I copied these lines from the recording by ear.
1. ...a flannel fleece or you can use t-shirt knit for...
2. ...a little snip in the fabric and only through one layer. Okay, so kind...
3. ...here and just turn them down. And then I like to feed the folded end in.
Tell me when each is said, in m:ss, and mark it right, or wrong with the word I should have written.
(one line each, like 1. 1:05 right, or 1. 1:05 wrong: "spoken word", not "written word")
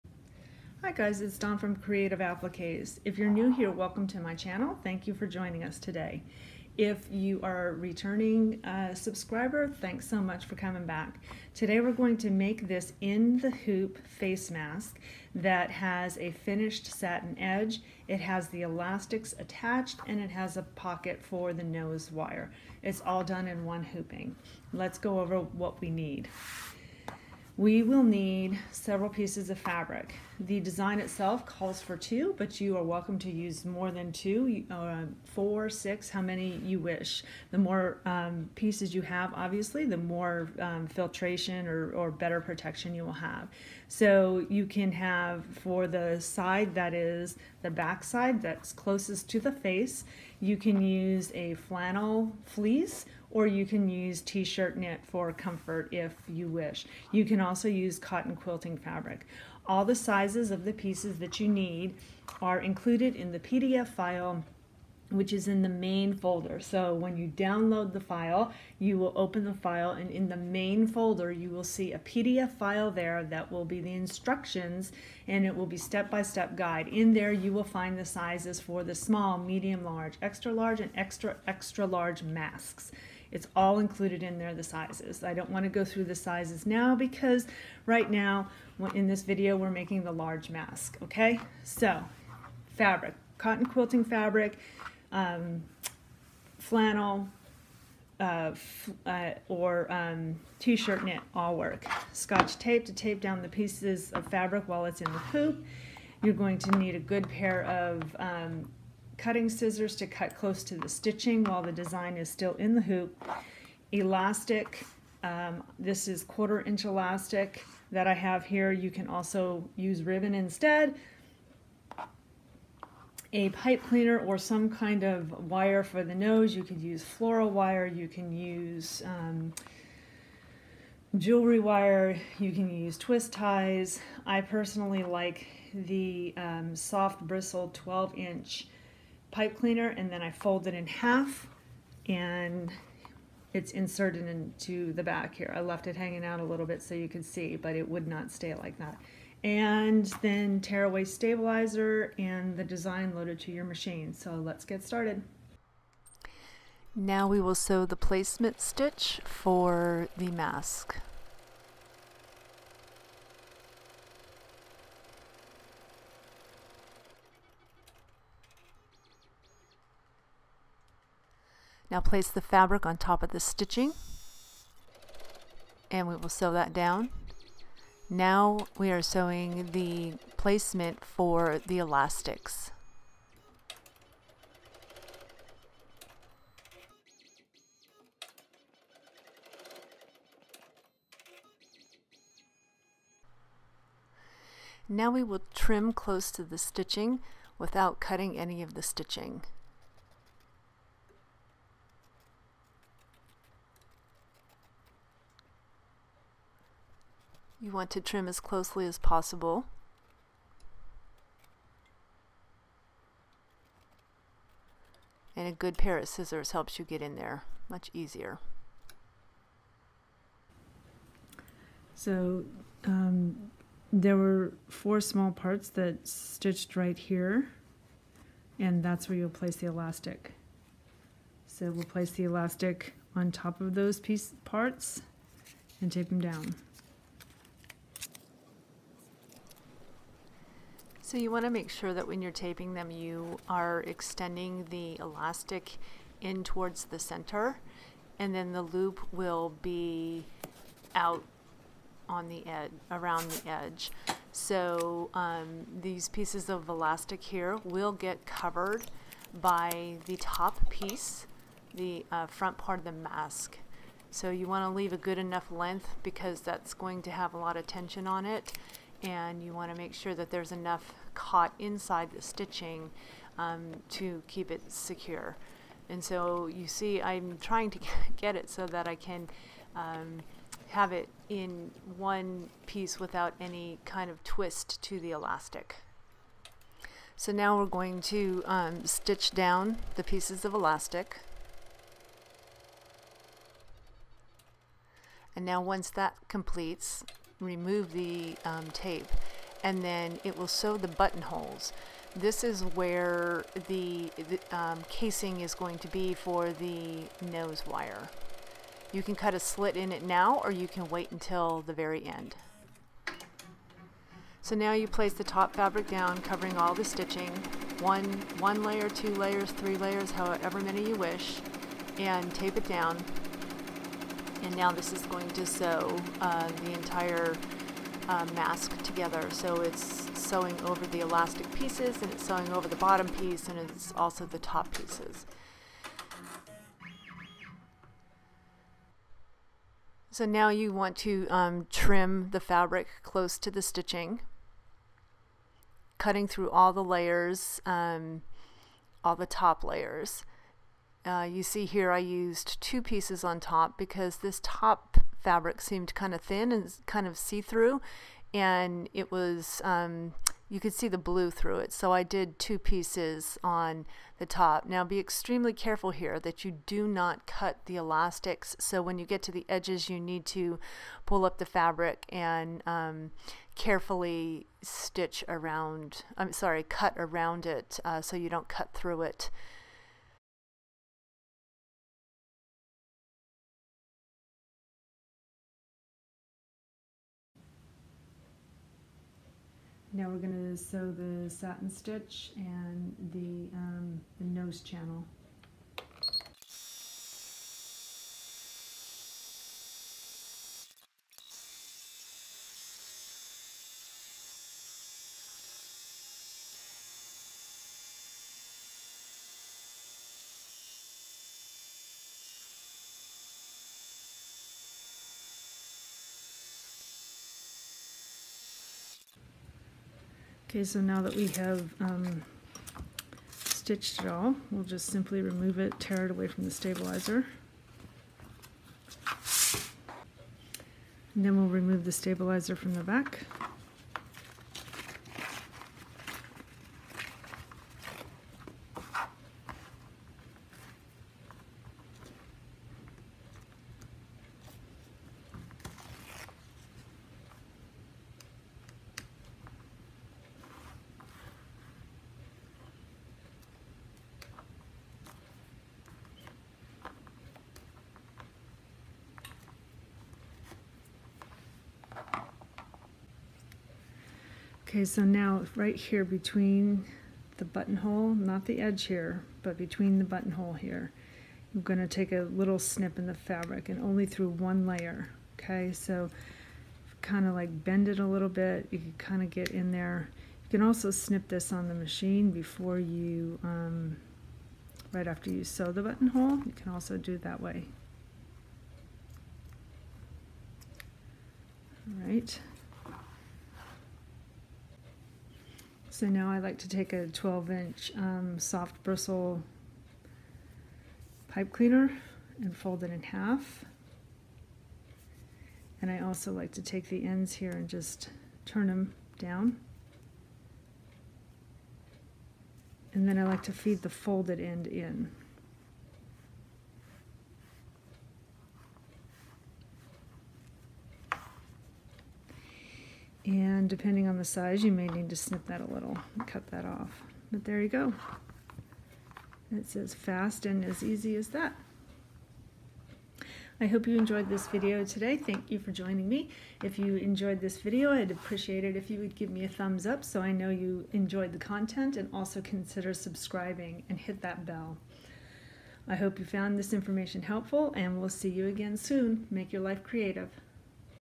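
1. 0:51 right
2. 7:52 right
3. 8:27 right.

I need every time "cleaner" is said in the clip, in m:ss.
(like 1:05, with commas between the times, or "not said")
2:03, 2:19, 8:21.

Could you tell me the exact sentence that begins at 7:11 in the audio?
And then we'll remove the stabilizer from the back.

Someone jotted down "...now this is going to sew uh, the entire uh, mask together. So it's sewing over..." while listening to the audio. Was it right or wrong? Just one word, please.
right.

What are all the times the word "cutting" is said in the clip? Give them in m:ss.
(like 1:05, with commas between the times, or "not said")
1:49, 3:17, 5:45.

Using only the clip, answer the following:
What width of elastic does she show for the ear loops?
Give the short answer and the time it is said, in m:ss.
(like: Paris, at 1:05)
quarter inch, at 1:56.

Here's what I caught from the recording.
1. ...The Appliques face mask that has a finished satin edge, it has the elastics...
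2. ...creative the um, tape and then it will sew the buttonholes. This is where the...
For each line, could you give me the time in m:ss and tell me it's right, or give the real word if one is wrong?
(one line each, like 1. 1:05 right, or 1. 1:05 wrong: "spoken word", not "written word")
1. 0:13 wrong: "Hoop", not "Appliques"
2. 4:57 wrong: "remove", not "creative".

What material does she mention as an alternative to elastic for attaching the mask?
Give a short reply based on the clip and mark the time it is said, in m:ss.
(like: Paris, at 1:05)
ribbon, at 2:00.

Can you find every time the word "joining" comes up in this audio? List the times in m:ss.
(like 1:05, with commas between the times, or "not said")
0:05, 8:55.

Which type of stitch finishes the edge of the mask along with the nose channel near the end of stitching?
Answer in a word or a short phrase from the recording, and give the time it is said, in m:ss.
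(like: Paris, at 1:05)
satin stitch, at 6:31.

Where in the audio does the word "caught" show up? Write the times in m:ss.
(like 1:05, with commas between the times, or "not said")
4:31.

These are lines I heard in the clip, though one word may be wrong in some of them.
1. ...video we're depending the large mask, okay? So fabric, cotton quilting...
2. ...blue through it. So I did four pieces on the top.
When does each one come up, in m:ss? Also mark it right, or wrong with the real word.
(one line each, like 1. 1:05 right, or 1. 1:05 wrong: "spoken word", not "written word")
1. 1:29 wrong: "making", not "depending"
2. 6:00 wrong: "two", not "four".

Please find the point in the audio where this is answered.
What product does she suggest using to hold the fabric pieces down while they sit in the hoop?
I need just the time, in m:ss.
1:42.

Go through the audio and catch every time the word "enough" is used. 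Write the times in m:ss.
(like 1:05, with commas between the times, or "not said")
4:25, 4:30.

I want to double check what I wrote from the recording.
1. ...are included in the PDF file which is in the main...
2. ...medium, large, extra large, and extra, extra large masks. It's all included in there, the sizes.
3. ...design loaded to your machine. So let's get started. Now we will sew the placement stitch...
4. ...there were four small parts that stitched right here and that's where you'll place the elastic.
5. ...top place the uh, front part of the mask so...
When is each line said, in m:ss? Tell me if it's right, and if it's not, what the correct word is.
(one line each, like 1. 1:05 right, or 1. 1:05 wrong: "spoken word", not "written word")
1. 1:02 right
2. 1:19 right
3. 2:32 right
4. 3:43 right
5. 4:20 wrong: "piece", not "place".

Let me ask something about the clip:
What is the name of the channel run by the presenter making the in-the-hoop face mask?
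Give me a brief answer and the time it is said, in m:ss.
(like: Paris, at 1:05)
Creative Appliques, at 0:01.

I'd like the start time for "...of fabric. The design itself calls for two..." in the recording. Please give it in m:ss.
0:29.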